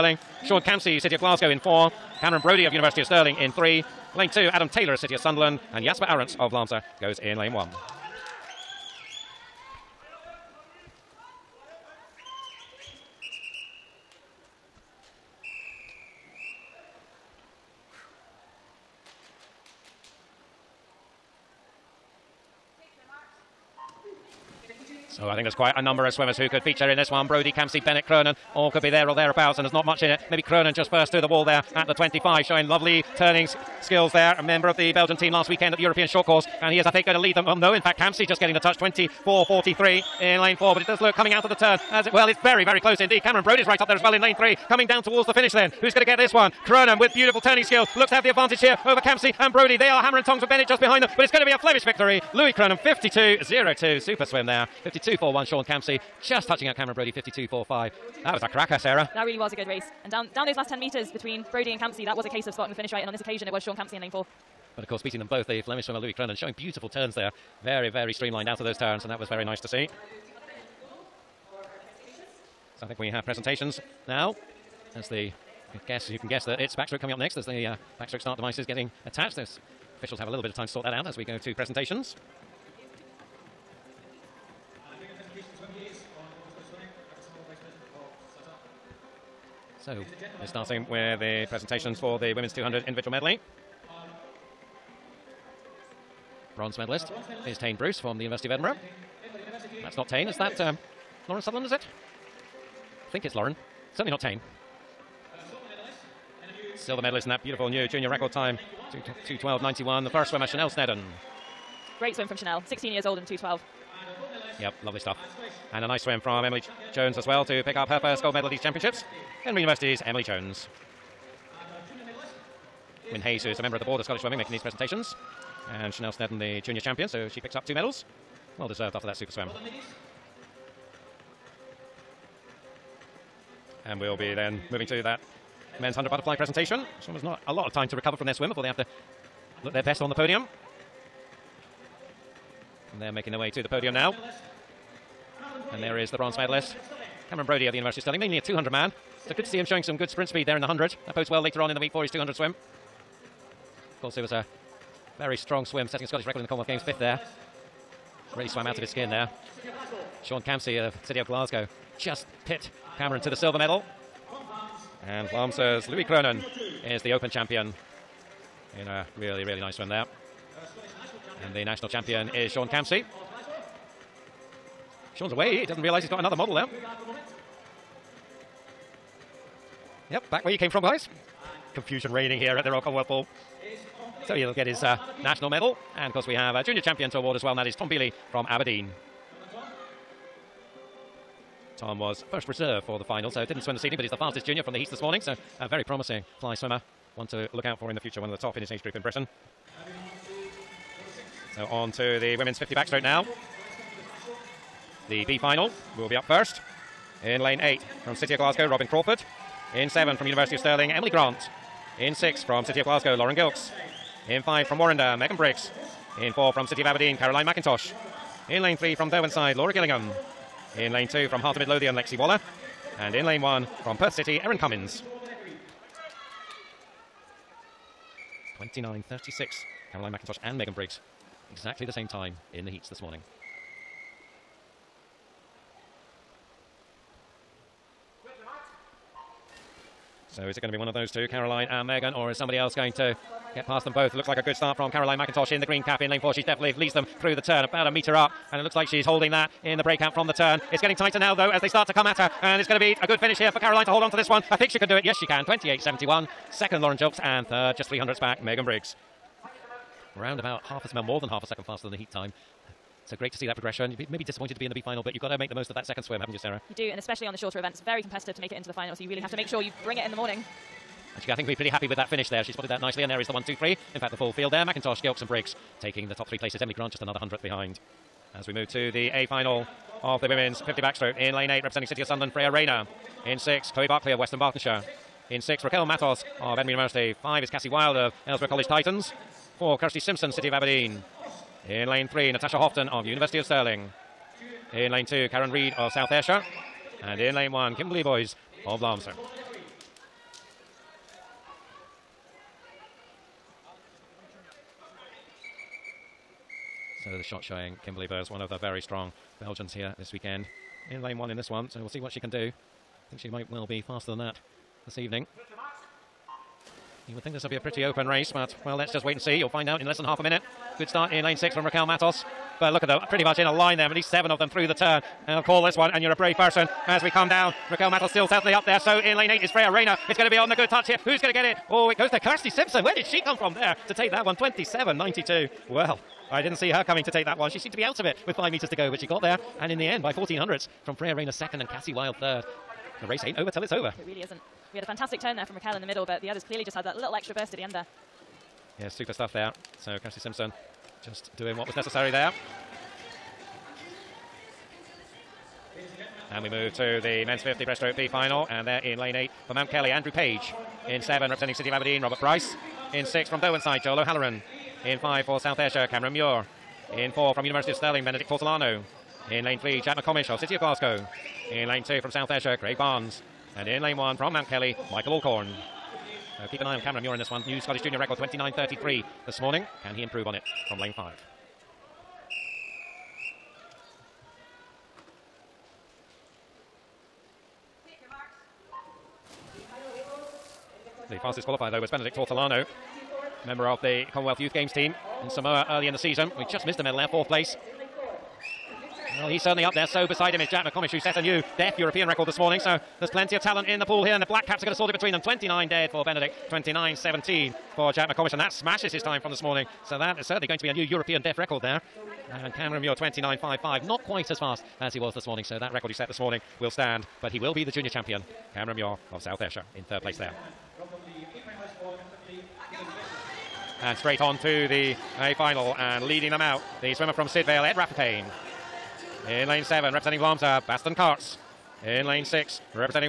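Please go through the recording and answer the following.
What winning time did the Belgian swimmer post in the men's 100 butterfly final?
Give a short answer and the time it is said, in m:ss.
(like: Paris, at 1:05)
52.2, at 0:52.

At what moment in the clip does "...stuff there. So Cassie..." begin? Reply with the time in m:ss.
5:49.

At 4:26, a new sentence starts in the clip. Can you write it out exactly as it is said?
You do, and especially on the shorter events, very competitive to make it into the final.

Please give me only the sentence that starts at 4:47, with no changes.
Five is Cassie Wild of Ellesmere College Titans.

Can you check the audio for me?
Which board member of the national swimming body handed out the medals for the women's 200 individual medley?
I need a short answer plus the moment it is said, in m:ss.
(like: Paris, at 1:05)
Wyn Hayes, at 2:03.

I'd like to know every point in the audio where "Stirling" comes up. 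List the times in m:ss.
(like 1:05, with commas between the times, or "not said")
0:03, 2:28, 3:30, 4:53, 6:07.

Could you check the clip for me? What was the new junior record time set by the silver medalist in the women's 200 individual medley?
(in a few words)
2:12.91.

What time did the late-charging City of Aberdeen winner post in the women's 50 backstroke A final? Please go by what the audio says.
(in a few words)
27.92.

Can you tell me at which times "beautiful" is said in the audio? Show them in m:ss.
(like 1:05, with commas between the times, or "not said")
0:47, 1:06, 1:47.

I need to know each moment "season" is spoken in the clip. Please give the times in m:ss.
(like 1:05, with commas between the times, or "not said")
6:35.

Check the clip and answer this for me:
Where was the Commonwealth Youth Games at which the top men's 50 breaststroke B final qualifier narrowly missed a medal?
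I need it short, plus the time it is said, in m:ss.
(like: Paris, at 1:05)
Samoa, at 6:35.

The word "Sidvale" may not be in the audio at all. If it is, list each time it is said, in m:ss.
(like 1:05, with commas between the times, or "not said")
7:07.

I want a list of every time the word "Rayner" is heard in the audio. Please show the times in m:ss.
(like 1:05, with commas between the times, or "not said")
4:42, 5:29, 5:41.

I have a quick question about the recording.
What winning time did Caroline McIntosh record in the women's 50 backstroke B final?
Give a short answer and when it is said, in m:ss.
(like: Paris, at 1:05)
28.71, at 4:15.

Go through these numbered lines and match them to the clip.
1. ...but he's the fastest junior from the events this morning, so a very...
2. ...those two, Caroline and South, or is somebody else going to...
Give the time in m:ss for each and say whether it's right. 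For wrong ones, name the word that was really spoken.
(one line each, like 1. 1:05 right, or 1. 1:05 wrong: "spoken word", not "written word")
1. 3:13 wrong: "heats", not "events"
2. 4:00 wrong: "Megan", not "South".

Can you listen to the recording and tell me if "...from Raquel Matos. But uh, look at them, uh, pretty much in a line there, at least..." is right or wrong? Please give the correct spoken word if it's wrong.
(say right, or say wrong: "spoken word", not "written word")
right.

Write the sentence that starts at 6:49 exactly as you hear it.
So that is certainly going to be a new European deaf record there.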